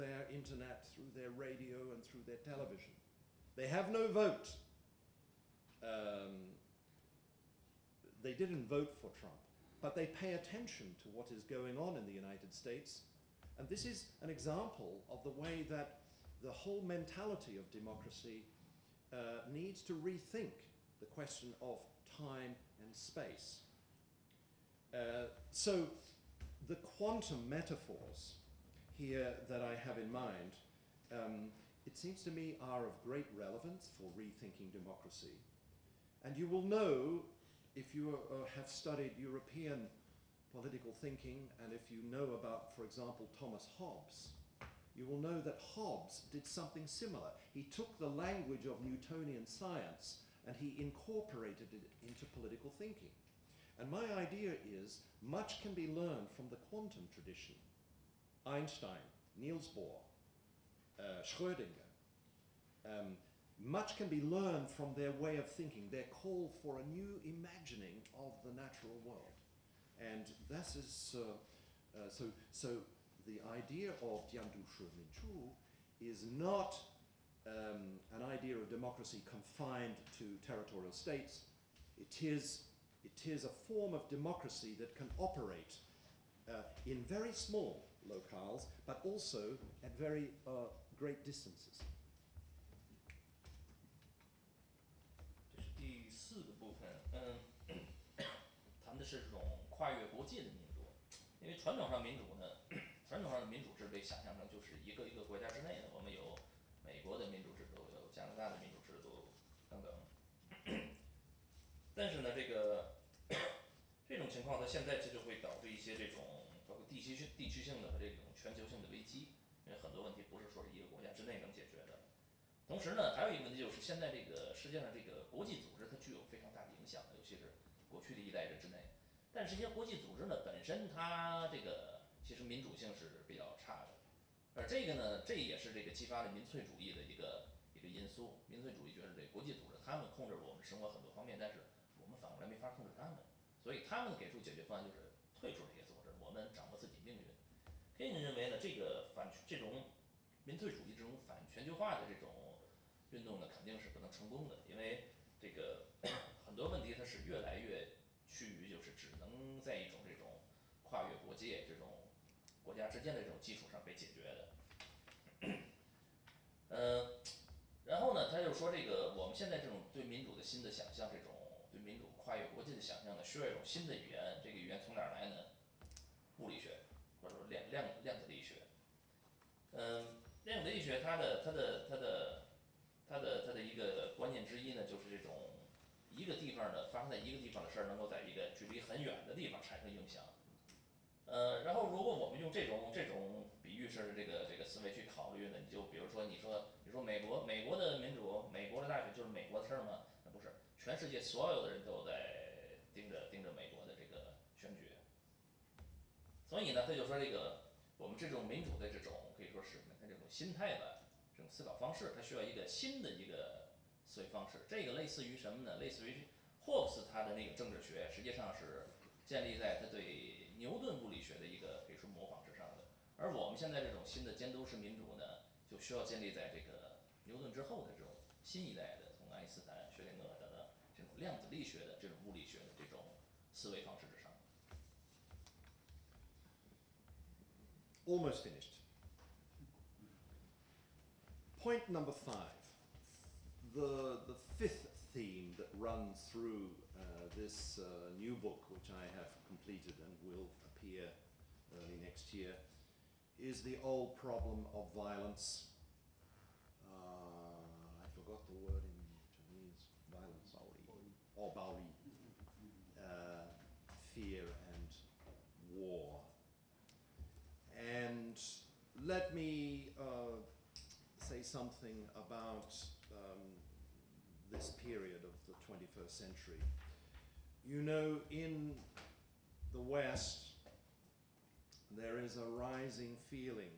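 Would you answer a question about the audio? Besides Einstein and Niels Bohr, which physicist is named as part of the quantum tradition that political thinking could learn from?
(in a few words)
Schrödinger.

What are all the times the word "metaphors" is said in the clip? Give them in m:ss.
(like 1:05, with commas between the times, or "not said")
0:27.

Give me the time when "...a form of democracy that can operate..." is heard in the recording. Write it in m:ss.
1:23.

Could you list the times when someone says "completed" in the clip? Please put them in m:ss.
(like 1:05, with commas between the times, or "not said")
4:09.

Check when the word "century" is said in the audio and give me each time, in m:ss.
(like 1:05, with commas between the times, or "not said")
4:36.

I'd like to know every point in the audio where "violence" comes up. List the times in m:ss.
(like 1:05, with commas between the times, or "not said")
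4:14, 4:20.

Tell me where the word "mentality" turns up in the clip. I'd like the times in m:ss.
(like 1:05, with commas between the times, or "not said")
0:16.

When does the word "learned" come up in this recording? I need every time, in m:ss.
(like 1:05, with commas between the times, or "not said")
0:55, 1:04.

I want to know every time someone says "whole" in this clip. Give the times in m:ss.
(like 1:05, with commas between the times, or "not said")
0:16.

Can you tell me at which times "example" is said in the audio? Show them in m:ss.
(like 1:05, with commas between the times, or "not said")
0:14, 0:42.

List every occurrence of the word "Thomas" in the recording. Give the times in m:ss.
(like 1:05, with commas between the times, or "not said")
0:43.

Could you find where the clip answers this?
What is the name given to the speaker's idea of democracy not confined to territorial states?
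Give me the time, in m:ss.
1:14.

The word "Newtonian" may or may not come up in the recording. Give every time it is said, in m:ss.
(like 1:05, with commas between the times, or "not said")
0:48.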